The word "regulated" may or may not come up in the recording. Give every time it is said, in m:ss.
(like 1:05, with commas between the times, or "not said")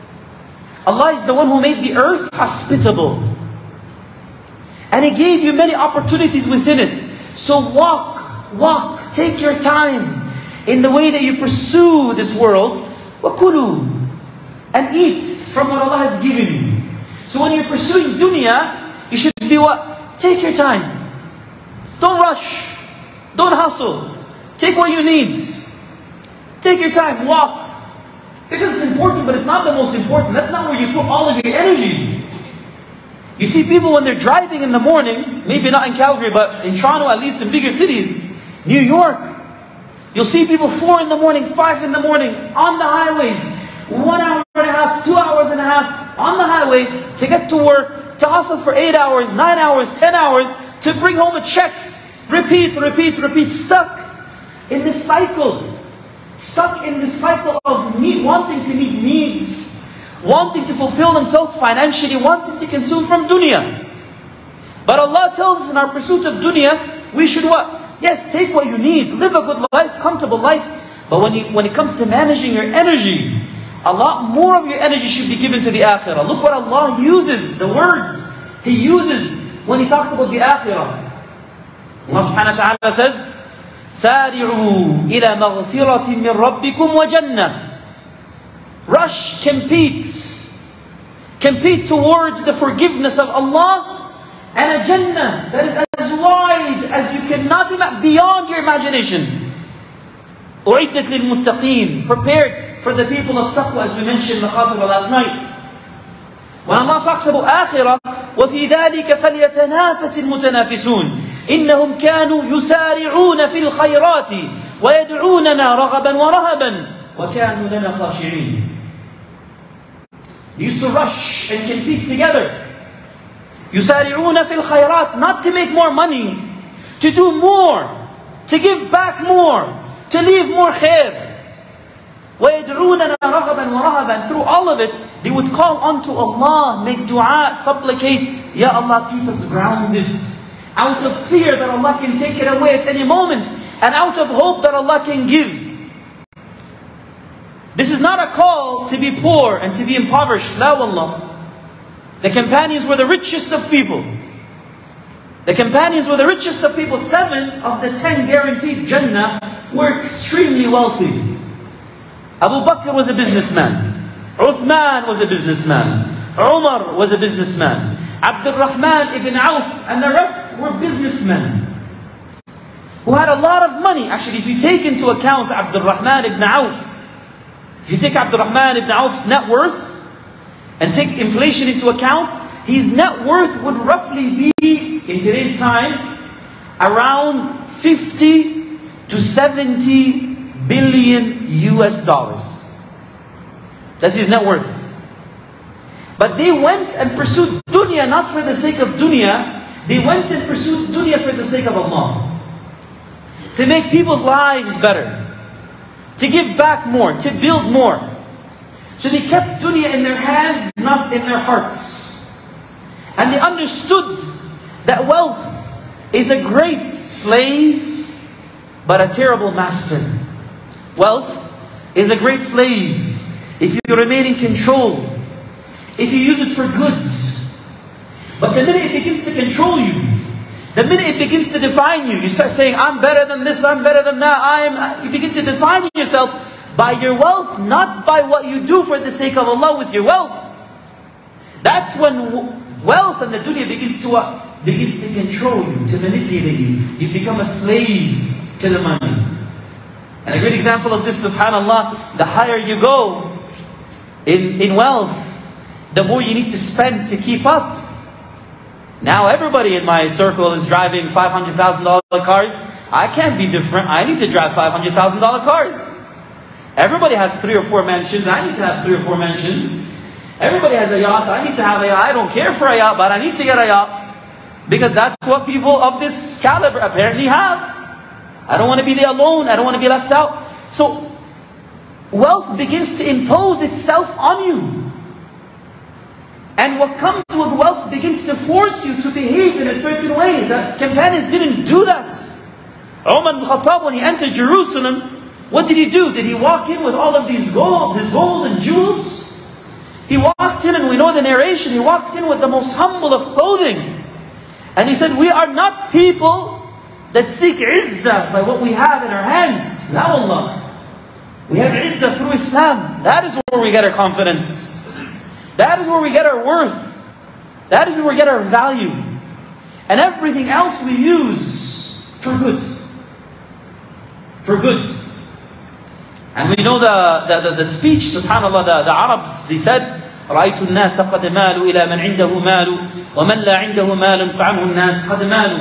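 not said.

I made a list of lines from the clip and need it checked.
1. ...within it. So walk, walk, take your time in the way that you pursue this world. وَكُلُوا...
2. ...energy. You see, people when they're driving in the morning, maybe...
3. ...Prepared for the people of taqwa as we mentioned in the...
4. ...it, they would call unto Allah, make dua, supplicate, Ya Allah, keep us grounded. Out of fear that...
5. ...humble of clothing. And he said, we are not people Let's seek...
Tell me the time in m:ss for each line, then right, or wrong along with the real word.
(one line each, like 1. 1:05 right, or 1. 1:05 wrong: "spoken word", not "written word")
1. 0:06 right
2. 0:31 right
3. 1:42 right
4. 2:14 right
5. 5:02 right.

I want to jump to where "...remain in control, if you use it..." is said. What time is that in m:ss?
3:43.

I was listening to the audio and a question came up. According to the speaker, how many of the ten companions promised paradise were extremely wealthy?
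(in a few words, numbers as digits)
7.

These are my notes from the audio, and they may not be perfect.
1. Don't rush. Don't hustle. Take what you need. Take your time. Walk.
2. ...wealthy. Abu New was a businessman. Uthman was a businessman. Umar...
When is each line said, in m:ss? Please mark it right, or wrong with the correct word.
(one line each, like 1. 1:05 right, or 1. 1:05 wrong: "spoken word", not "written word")
1. 0:21 right
2. 2:40 wrong: "Bakr", not "New".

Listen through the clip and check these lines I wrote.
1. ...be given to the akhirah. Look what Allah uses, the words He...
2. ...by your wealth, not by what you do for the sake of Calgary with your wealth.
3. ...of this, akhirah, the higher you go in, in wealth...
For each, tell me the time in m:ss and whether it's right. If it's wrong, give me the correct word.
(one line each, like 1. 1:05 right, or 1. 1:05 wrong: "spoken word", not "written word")
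1. 1:15 right
2. 3:56 wrong: "Allah", not "Calgary"
3. 4:10 wrong: "subhanAllah", not "akhirah".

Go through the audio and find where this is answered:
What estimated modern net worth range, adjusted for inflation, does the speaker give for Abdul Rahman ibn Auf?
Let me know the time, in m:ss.
3:07.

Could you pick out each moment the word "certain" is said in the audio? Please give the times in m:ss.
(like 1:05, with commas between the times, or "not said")
4:49.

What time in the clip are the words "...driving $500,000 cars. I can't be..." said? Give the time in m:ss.
4:20.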